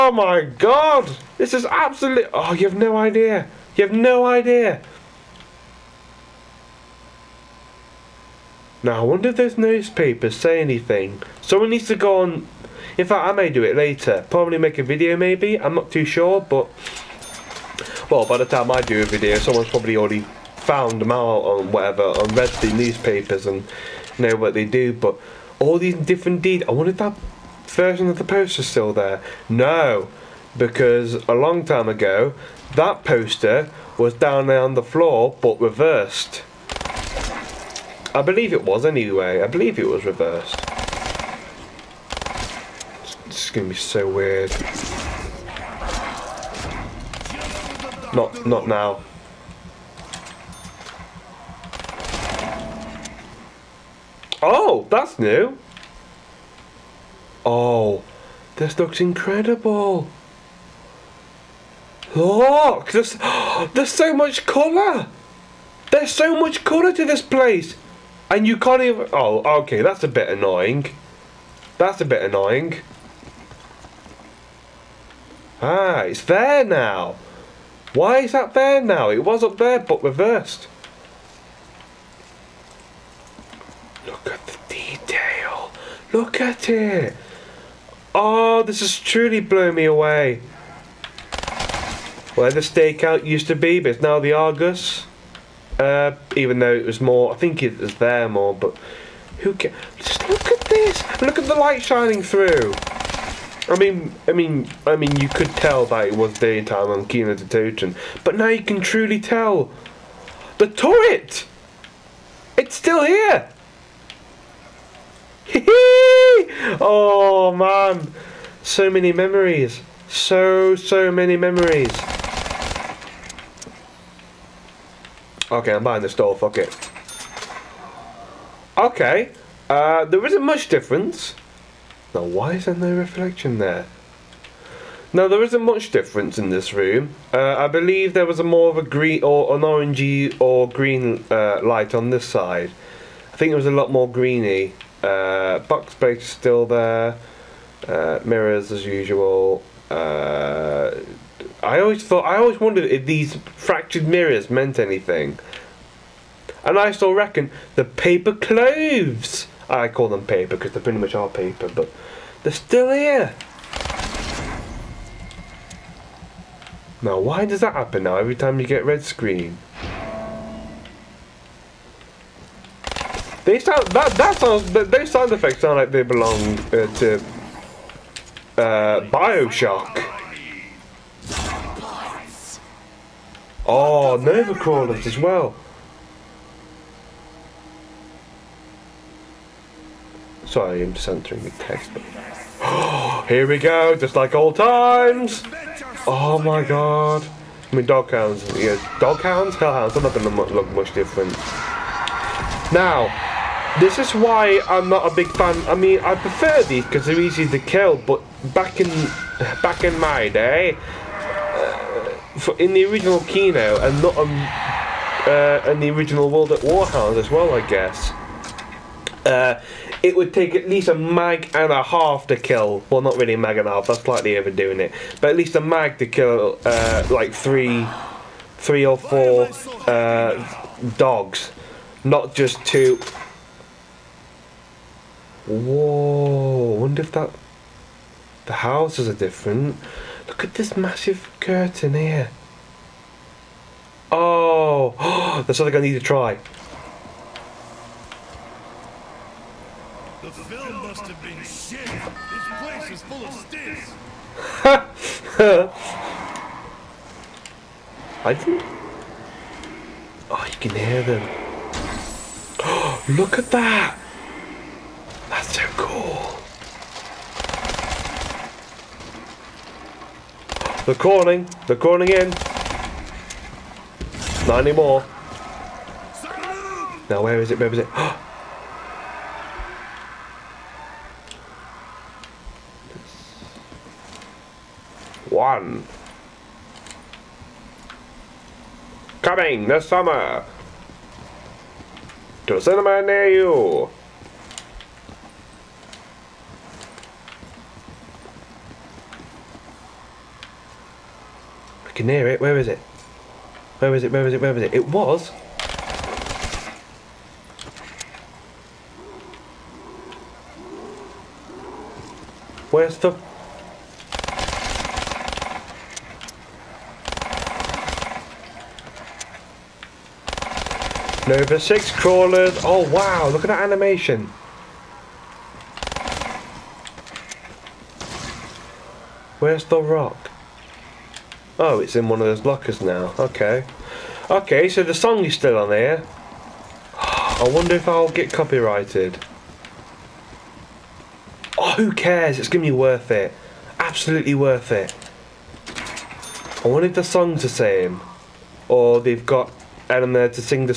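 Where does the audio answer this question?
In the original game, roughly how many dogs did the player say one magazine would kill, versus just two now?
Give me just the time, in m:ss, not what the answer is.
3:48.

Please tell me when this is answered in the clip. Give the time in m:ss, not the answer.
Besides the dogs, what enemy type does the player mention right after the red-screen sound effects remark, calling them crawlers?
3:04.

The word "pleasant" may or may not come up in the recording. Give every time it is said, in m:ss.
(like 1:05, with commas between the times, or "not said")
not said.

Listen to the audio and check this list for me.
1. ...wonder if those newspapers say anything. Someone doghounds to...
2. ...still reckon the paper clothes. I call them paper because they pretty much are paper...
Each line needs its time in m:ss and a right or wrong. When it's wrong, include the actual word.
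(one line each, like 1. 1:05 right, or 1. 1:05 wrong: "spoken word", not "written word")
1. 0:09 wrong: "needs", not "doghounds"
2. 2:36 right.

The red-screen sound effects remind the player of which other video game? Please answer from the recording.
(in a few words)
Bioshock.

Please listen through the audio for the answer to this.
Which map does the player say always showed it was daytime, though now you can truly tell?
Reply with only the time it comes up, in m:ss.
1:47.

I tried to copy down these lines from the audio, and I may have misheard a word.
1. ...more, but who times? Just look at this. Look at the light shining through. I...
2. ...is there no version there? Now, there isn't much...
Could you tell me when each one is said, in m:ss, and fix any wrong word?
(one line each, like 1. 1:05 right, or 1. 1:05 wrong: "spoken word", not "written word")
1. 1:38 wrong: "cares", not "times"
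2. 2:12 wrong: "reflection", not "version".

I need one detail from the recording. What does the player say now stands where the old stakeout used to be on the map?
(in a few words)
The Argus.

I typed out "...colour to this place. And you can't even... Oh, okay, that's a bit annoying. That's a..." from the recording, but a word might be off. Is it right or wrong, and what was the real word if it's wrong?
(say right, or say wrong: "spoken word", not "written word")
right.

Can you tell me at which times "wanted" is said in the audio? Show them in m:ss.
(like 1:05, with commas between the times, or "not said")
0:26.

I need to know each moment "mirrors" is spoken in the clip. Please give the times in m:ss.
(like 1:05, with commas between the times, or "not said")
2:28, 2:34.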